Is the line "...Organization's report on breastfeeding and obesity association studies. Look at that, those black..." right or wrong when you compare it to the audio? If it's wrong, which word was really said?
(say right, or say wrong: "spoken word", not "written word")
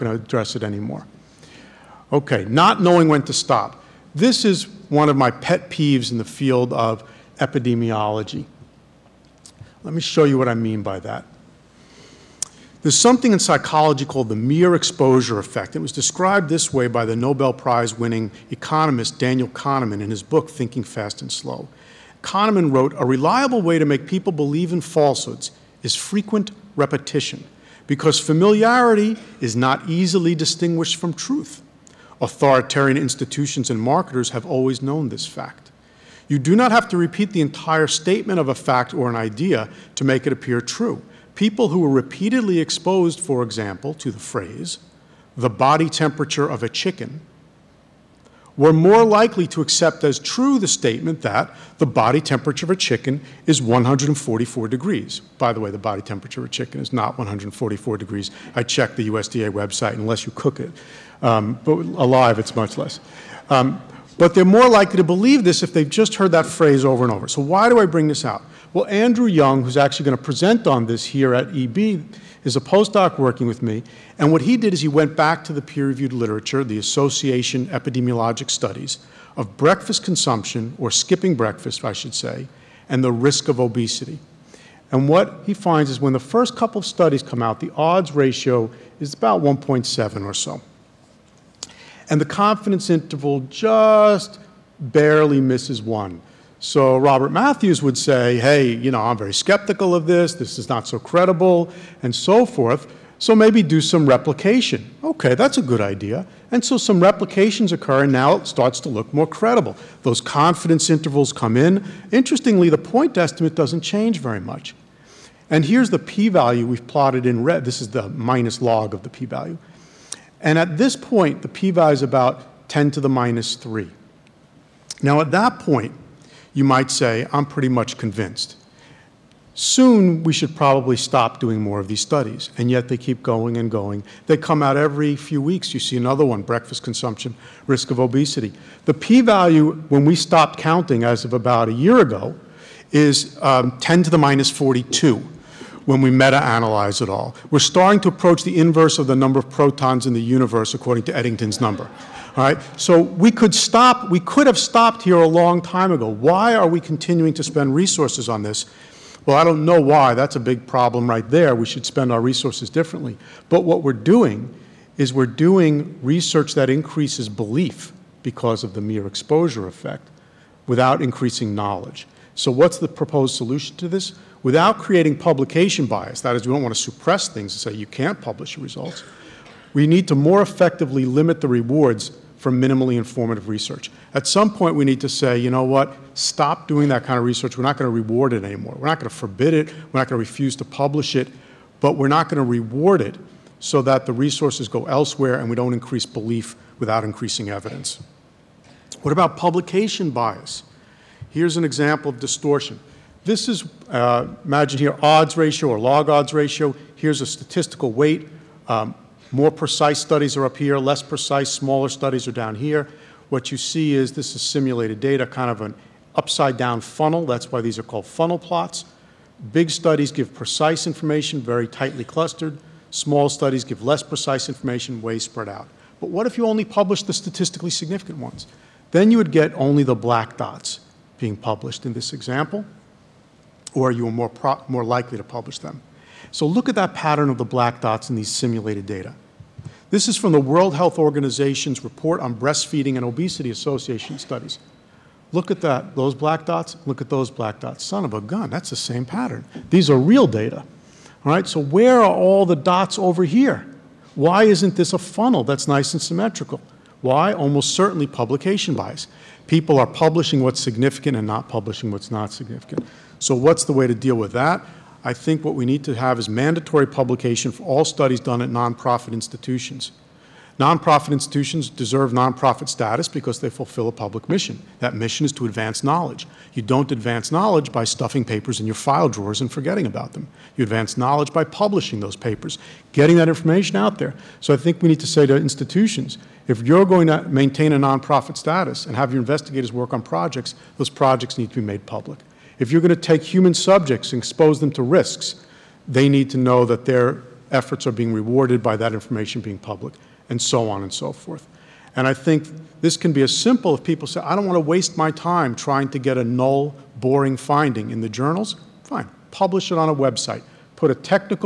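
right.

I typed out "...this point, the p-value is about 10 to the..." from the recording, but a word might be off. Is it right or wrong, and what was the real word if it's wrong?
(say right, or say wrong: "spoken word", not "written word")
right.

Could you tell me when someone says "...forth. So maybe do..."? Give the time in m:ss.
1:42.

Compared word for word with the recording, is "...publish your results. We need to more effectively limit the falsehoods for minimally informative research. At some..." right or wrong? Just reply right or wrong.
wrong.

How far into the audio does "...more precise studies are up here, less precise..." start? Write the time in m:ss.
3:29.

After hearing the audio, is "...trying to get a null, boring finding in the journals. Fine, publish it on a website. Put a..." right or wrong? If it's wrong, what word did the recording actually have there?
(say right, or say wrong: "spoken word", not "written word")
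right.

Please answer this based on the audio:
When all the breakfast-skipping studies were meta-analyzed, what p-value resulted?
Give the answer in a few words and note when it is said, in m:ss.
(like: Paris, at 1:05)
10 to the minus 42, at 2:23.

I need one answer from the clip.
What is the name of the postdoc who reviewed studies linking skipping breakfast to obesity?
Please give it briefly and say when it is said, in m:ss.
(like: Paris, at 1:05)
Andrew Young, at 1:08.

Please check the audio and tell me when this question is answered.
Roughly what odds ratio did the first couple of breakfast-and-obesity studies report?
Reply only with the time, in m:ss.
1:29.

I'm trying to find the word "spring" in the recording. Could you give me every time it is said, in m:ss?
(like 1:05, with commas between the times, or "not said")
not said.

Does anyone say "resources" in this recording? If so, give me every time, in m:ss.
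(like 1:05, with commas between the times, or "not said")
2:37, 2:42, 3:14.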